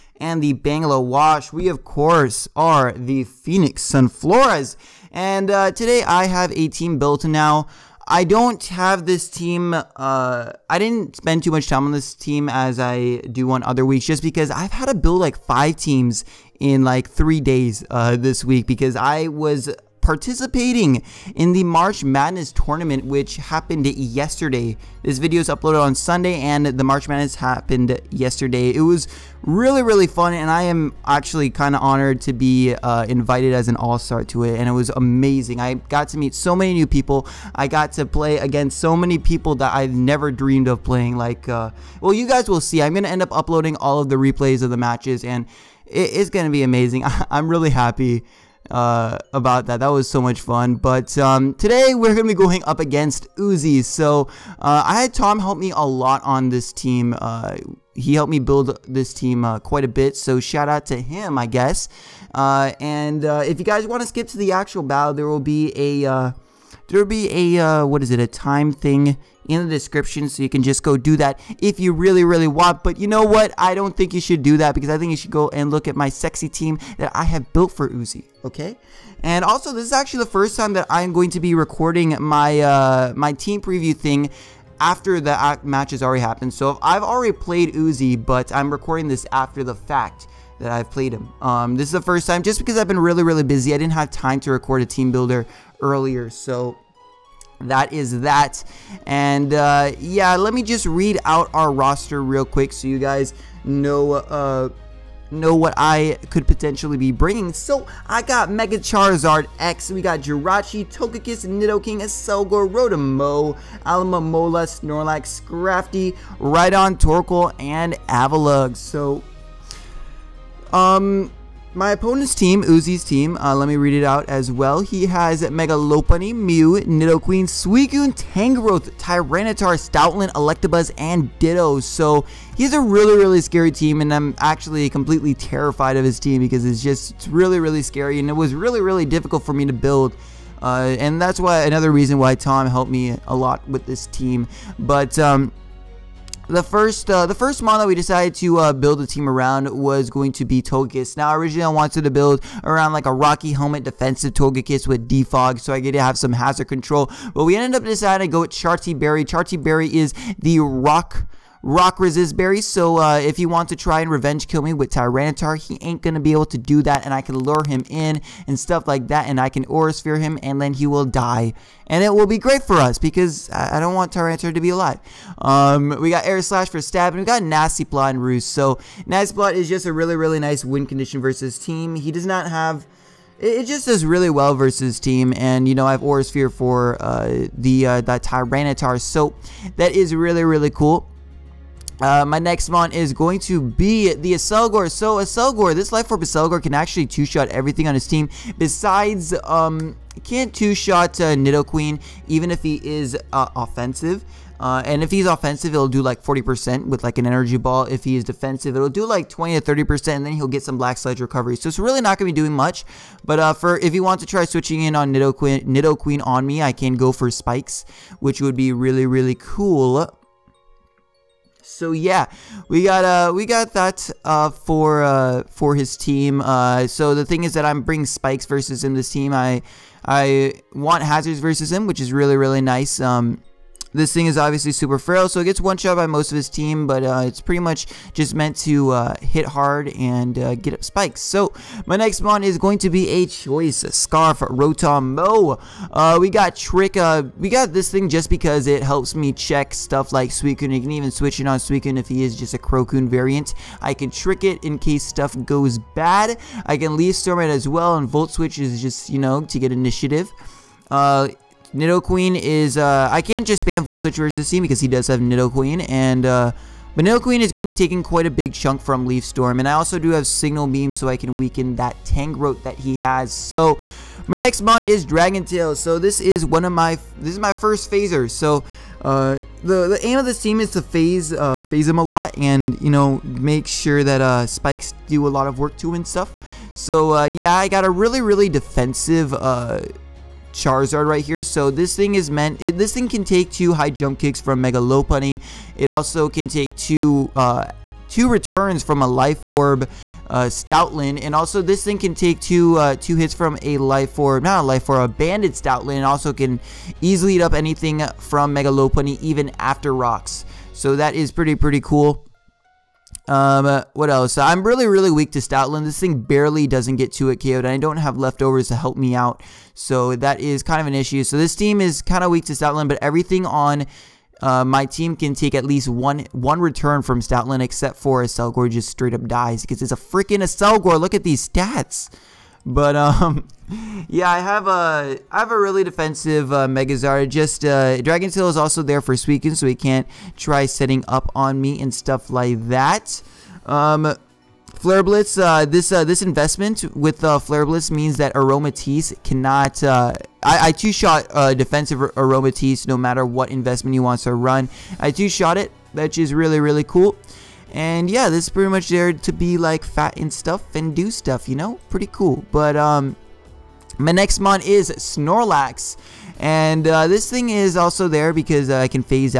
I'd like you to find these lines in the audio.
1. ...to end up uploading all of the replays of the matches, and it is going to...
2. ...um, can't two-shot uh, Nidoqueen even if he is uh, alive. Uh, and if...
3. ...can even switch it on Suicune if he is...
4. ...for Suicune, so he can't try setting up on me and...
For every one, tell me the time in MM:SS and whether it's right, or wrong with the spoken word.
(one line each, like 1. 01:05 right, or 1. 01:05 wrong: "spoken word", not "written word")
1. 00:43 right
2. 03:19 wrong: "offensive", not "alive"
3. 04:10 right
4. 05:39 right.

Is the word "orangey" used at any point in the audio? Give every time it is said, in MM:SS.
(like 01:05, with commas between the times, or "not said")
not said.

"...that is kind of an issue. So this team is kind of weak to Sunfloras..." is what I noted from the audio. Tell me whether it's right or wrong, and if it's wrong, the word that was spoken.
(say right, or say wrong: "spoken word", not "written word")
wrong: "Stoutland", not "Sunfloras".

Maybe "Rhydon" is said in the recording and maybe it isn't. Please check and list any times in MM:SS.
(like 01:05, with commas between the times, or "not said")
01:56.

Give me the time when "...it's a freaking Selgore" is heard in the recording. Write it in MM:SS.
05:29.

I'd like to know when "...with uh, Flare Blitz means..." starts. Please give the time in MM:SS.
05:46.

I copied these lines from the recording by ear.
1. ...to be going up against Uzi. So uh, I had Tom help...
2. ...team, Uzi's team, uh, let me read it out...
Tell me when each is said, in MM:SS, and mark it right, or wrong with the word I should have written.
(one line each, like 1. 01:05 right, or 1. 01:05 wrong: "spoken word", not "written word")
1. 00:52 right
2. 02:02 right.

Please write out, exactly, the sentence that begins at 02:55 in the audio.
Um, we got Air Slash for stab and we got Nasty Plot and Roost.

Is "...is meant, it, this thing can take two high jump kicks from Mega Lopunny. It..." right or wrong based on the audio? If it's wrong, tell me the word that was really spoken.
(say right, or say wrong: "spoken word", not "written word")
right.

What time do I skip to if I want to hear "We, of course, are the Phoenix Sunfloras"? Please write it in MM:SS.
00:01.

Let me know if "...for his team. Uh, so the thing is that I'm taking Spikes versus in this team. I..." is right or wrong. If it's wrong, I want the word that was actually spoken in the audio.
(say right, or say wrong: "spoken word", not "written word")
wrong: "bringing", not "taking".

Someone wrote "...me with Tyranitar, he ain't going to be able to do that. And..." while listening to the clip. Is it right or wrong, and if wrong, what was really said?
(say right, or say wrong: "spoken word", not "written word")
right.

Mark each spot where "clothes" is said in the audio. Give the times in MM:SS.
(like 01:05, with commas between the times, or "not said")
not said.